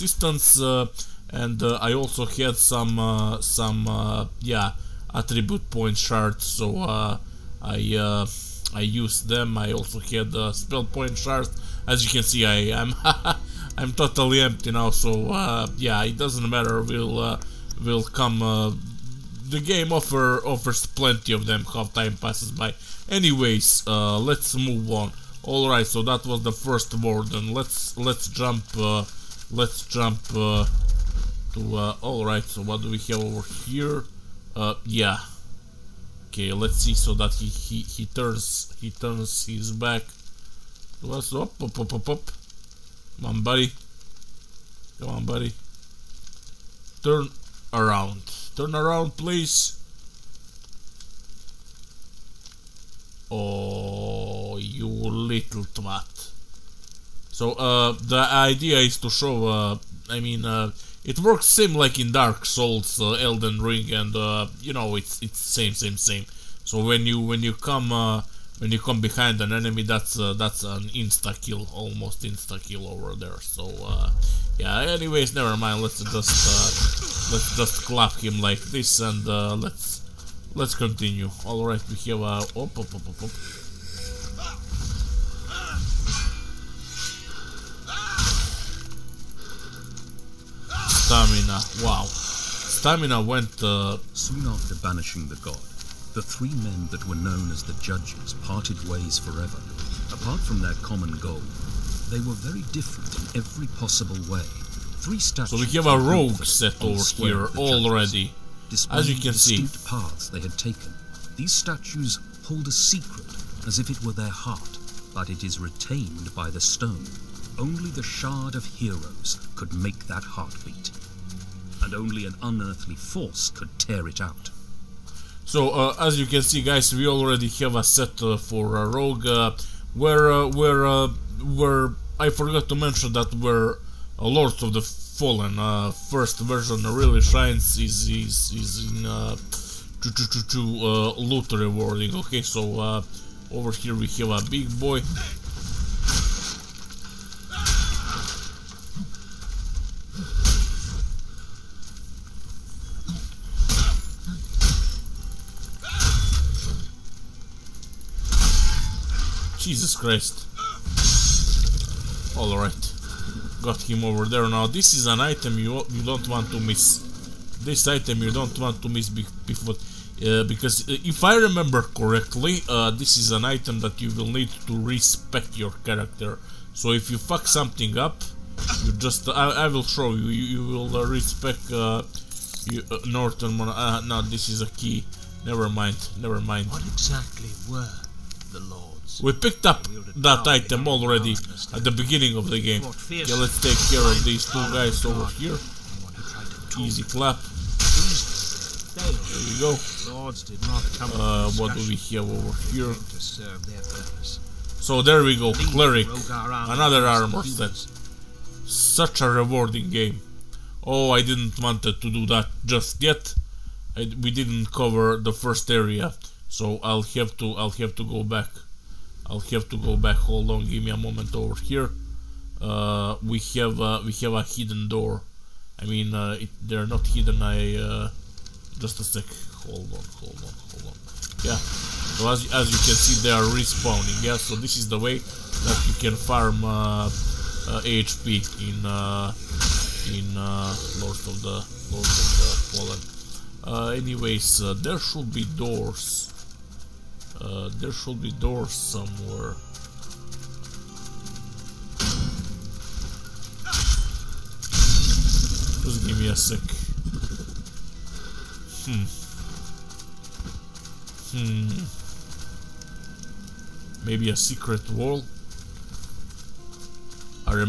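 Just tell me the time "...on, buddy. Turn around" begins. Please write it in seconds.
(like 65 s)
45 s.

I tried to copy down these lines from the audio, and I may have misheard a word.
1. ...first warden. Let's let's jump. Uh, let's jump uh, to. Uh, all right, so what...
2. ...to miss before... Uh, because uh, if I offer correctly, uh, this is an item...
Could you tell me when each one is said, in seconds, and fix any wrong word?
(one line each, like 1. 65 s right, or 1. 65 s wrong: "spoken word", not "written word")
1. 26 s right
2. 168 s wrong: "remember", not "offer".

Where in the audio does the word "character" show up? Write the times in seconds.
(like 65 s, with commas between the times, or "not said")
175 s.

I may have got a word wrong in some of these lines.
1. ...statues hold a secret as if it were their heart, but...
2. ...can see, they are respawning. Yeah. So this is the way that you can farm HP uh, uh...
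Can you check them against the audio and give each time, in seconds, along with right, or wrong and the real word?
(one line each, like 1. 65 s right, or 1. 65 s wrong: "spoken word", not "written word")
1. 111 s right
2. 232 s right.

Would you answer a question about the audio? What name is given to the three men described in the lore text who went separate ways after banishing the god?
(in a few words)
The judges.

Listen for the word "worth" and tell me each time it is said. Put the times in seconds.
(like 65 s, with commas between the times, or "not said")
not said.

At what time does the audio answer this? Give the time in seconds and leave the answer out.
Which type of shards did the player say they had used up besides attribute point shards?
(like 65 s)
10 s.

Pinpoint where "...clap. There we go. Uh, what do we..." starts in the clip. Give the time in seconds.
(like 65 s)
197 s.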